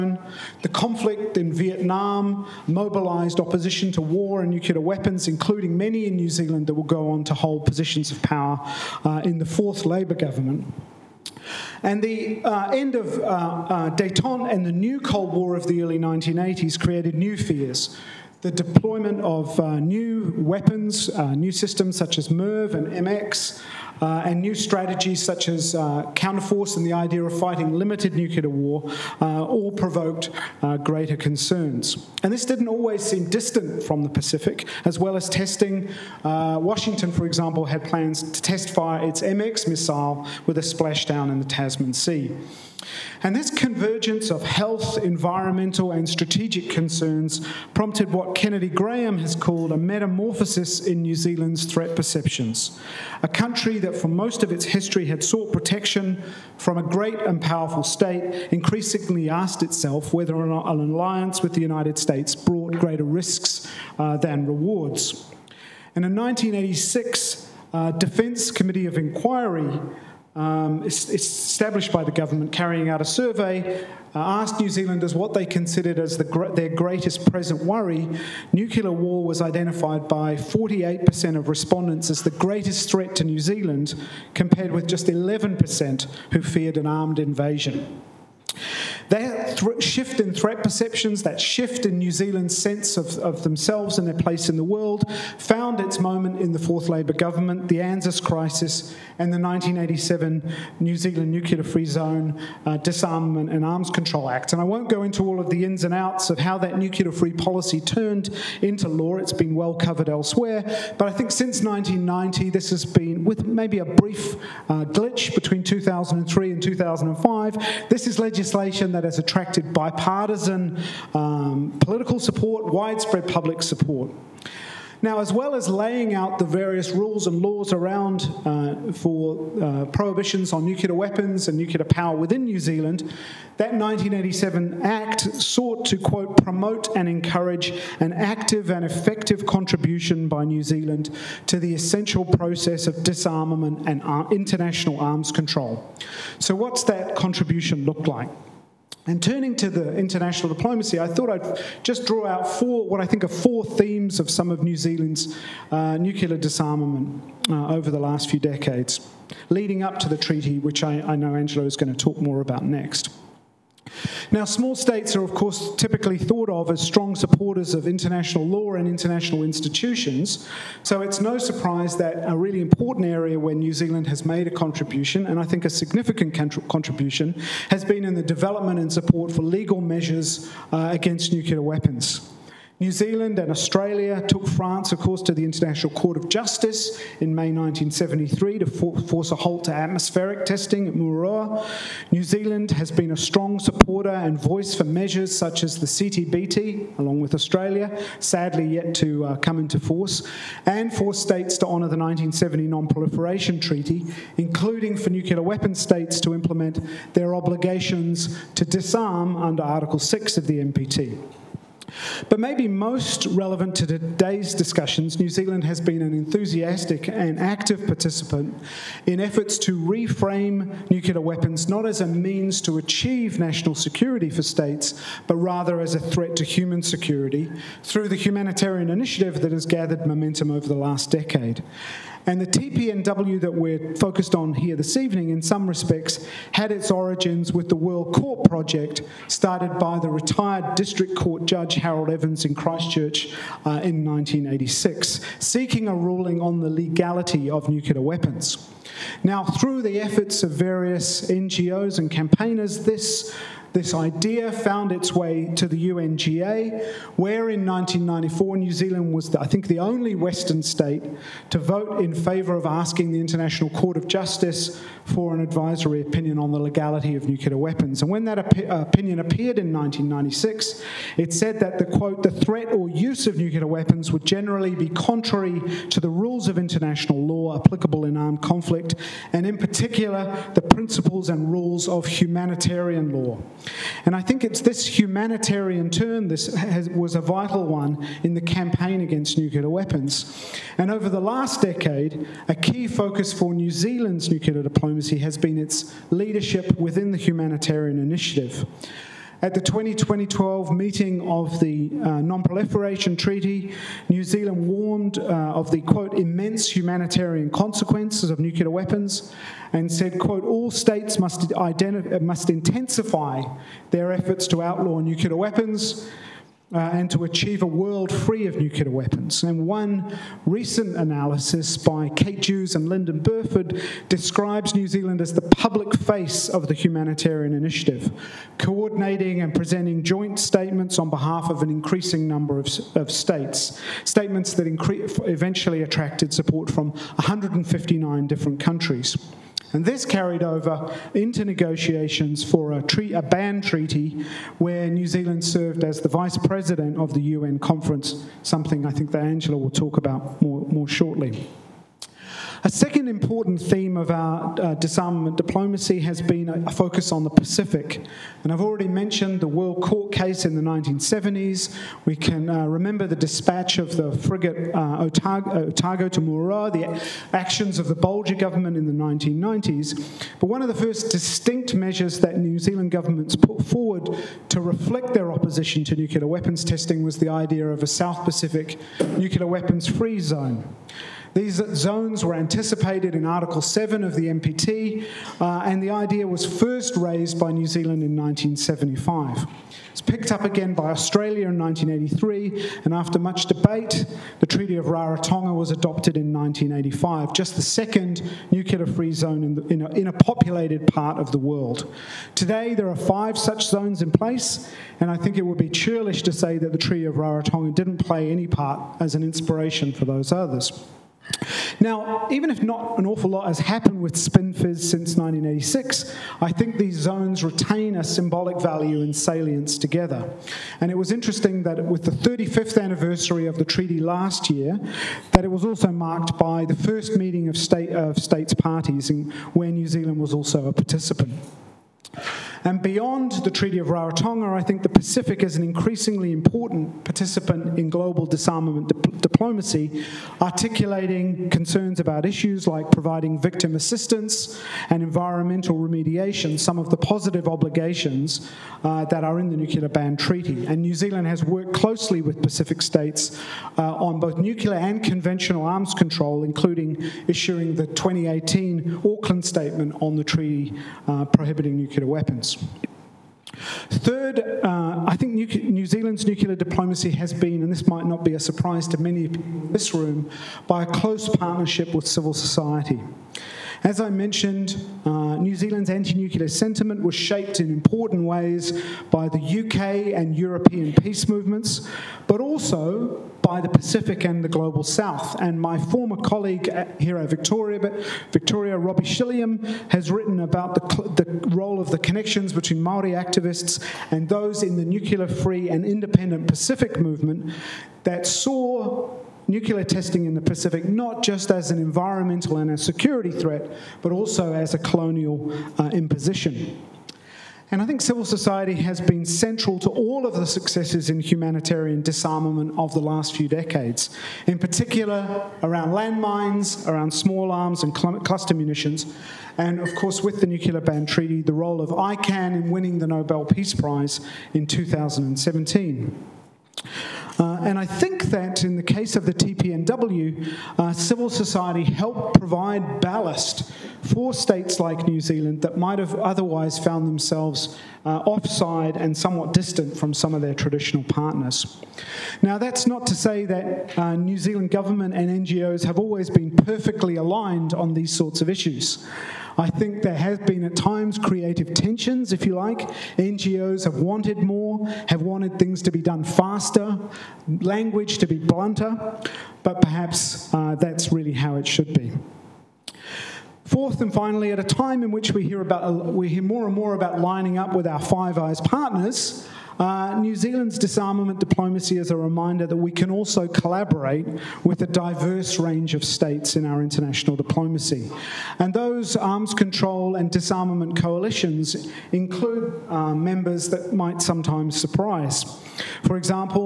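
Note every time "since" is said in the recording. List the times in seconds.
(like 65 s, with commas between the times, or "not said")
111 s, 414 s.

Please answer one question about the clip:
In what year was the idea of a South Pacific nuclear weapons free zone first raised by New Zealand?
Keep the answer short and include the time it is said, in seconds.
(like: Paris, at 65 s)
1975, at 388 s.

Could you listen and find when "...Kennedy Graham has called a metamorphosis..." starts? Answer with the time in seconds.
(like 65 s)
48 s.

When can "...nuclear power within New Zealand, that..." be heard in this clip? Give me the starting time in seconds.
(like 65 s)
131 s.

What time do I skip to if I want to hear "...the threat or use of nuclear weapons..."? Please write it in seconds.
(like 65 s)
272 s.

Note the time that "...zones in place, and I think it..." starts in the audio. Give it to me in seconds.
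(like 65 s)
403 s.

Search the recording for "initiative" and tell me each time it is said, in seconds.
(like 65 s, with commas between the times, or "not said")
228 s, 297 s, 327 s.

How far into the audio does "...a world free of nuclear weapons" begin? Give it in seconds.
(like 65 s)
317 s.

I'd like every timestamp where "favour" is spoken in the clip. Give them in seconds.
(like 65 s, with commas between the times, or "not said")
262 s.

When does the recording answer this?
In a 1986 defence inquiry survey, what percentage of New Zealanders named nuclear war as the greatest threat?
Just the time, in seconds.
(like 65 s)
80 s.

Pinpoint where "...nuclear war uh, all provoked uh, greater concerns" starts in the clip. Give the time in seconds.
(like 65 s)
28 s.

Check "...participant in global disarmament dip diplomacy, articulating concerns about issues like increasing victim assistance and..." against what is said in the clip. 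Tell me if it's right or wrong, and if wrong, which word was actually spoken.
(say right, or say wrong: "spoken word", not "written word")
wrong: "providing", not "increasing".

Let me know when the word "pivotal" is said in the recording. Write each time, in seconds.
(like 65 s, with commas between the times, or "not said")
not said.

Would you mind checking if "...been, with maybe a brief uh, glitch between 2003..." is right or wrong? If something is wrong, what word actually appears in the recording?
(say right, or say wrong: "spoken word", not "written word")
right.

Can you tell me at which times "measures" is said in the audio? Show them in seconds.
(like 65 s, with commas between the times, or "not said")
179 s, 194 s, 371 s.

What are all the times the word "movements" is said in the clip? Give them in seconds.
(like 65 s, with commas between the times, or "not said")
481 s, 496 s.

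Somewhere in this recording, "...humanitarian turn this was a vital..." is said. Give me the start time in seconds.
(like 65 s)
284 s.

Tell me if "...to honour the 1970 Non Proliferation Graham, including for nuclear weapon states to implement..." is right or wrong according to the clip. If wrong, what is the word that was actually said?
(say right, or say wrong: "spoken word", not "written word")
wrong: "Treaty", not "Graham".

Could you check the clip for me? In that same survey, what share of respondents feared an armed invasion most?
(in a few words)
11%.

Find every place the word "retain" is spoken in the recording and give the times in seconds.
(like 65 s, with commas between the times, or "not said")
417 s.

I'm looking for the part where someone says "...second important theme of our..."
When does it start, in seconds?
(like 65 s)
352 s.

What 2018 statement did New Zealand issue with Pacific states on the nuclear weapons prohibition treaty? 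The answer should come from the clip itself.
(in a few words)
Auckland Statement.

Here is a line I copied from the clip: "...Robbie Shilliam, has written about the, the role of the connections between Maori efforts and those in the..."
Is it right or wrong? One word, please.
wrong.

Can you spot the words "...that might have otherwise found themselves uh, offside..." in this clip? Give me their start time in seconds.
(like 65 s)
535 s.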